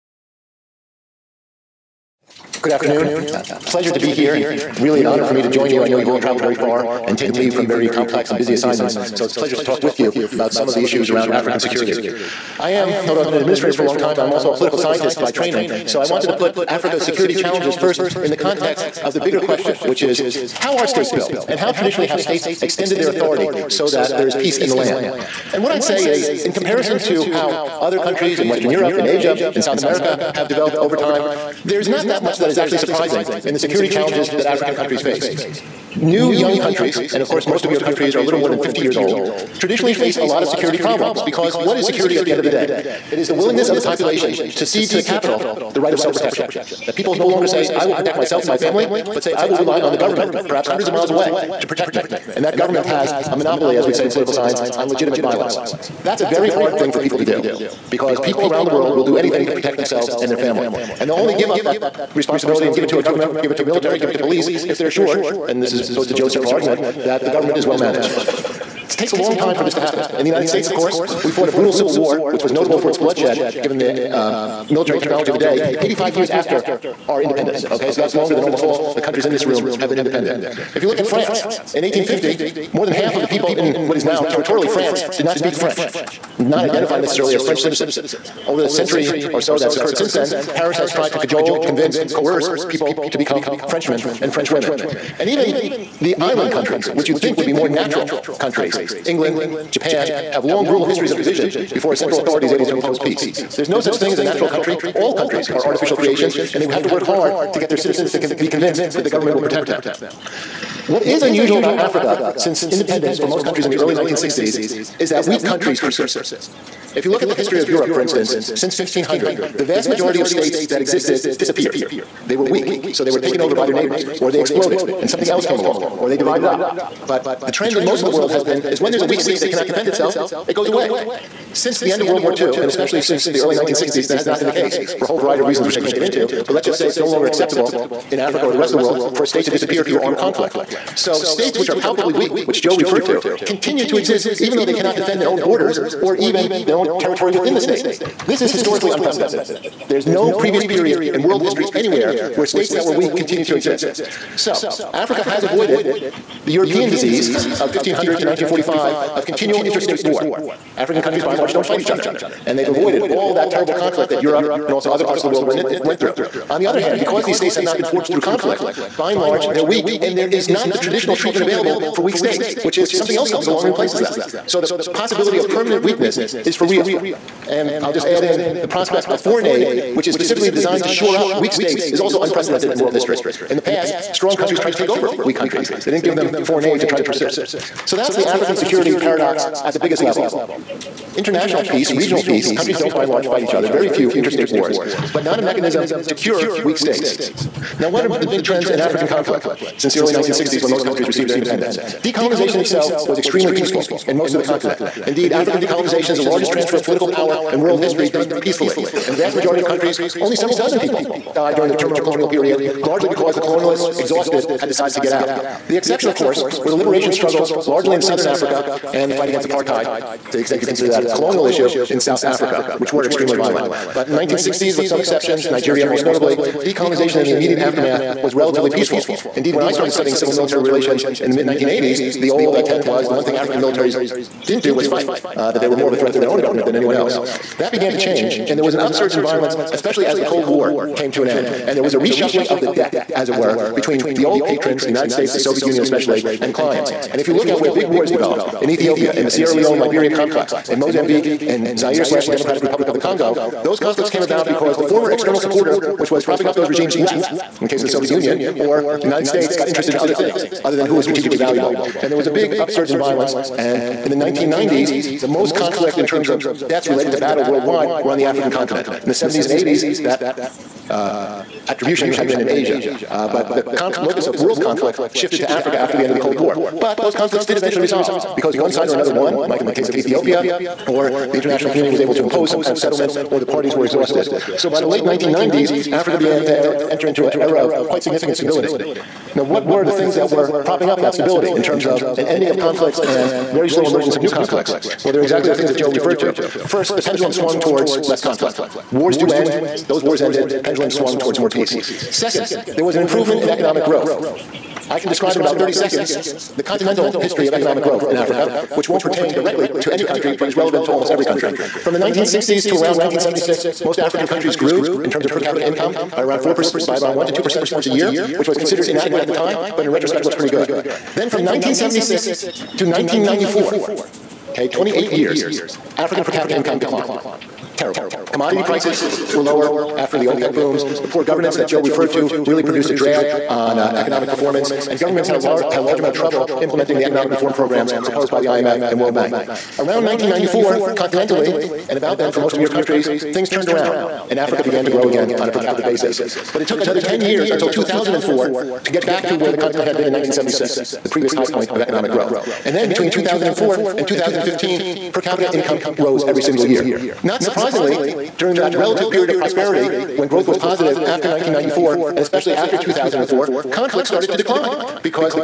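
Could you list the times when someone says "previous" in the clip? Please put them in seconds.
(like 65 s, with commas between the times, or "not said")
150 s, 351 s.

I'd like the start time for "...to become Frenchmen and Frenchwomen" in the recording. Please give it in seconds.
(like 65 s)
93 s.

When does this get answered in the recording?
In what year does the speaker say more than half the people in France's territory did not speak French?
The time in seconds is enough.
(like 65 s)
81 s.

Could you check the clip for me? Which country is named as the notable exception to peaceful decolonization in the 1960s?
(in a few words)
Nigeria.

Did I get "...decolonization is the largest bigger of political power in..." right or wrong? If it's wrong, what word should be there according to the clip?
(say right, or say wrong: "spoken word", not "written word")
wrong: "transfer", not "bigger".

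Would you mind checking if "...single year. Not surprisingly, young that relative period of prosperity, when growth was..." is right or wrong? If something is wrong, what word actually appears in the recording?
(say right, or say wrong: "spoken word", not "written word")
wrong: "during", not "young".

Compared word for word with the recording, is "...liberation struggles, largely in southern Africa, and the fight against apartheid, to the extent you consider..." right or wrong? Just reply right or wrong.
right.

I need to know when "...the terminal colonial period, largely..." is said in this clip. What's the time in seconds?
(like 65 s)
211 s.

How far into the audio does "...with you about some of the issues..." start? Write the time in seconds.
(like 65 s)
9 s.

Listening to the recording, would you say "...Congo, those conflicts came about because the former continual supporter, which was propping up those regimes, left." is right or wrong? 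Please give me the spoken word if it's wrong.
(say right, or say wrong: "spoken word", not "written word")
wrong: "external", not "continual".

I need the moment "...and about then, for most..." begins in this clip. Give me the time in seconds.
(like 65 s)
341 s.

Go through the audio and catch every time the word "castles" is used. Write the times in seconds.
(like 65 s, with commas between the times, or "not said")
not said.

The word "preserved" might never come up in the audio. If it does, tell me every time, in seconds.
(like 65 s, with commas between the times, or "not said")
not said.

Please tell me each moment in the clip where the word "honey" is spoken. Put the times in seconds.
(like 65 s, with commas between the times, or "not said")
not said.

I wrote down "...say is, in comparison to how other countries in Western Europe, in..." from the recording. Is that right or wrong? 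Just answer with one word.
right.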